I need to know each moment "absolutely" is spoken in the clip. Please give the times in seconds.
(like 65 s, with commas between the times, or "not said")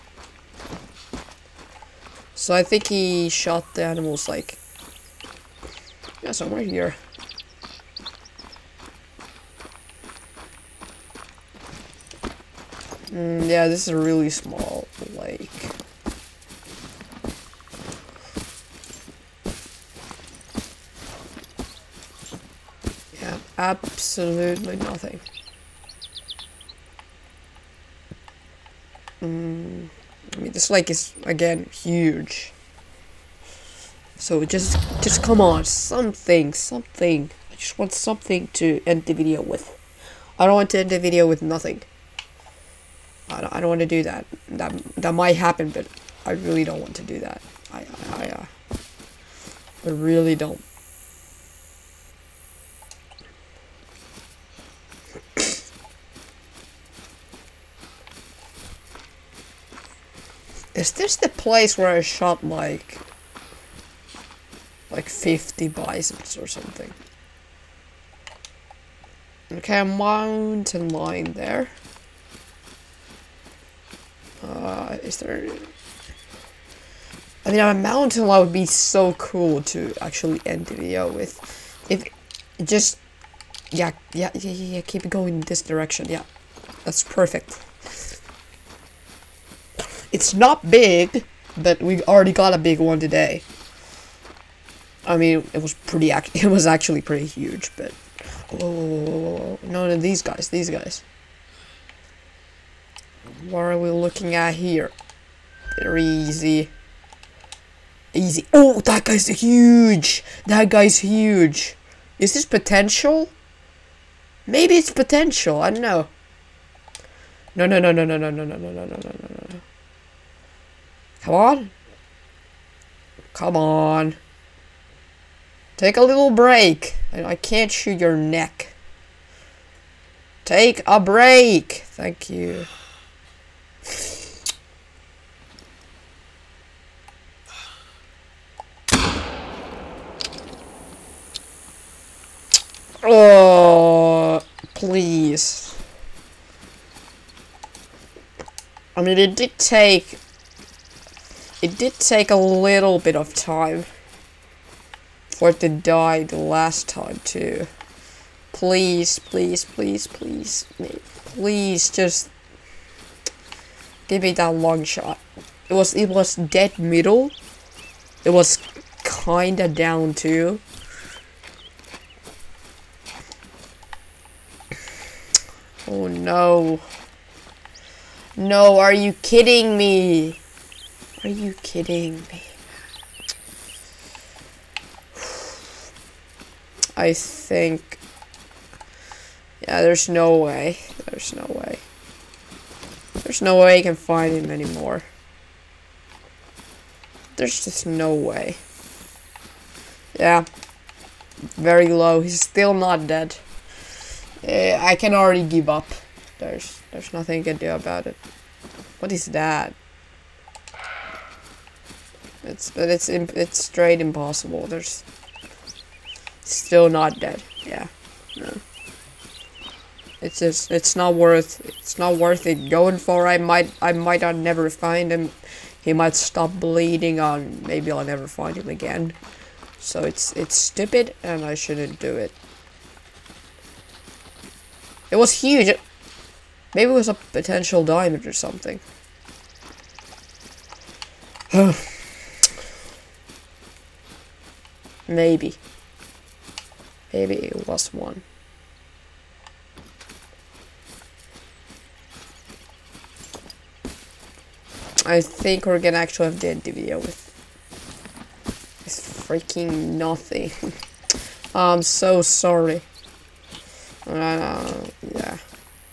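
23 s.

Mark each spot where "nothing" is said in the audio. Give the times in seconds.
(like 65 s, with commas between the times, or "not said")
24 s, 41 s, 207 s, 259 s.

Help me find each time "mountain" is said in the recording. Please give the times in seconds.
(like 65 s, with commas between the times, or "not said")
69 s, 77 s.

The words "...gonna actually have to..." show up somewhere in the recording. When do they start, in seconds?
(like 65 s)
255 s.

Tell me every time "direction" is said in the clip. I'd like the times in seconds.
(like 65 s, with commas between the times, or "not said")
85 s.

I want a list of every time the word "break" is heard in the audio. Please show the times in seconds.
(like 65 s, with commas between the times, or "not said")
126 s, 131 s.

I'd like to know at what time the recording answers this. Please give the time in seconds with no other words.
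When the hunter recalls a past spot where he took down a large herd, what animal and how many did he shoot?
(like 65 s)
65 s.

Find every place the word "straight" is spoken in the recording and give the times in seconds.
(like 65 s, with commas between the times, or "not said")
213 s.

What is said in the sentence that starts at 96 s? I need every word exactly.
it was actually pretty huge, but oh no, no, these guys, these guys.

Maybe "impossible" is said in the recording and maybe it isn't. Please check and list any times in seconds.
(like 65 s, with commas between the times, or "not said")
213 s.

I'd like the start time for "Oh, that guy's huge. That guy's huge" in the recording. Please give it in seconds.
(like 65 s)
108 s.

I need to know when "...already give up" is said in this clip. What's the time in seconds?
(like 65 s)
205 s.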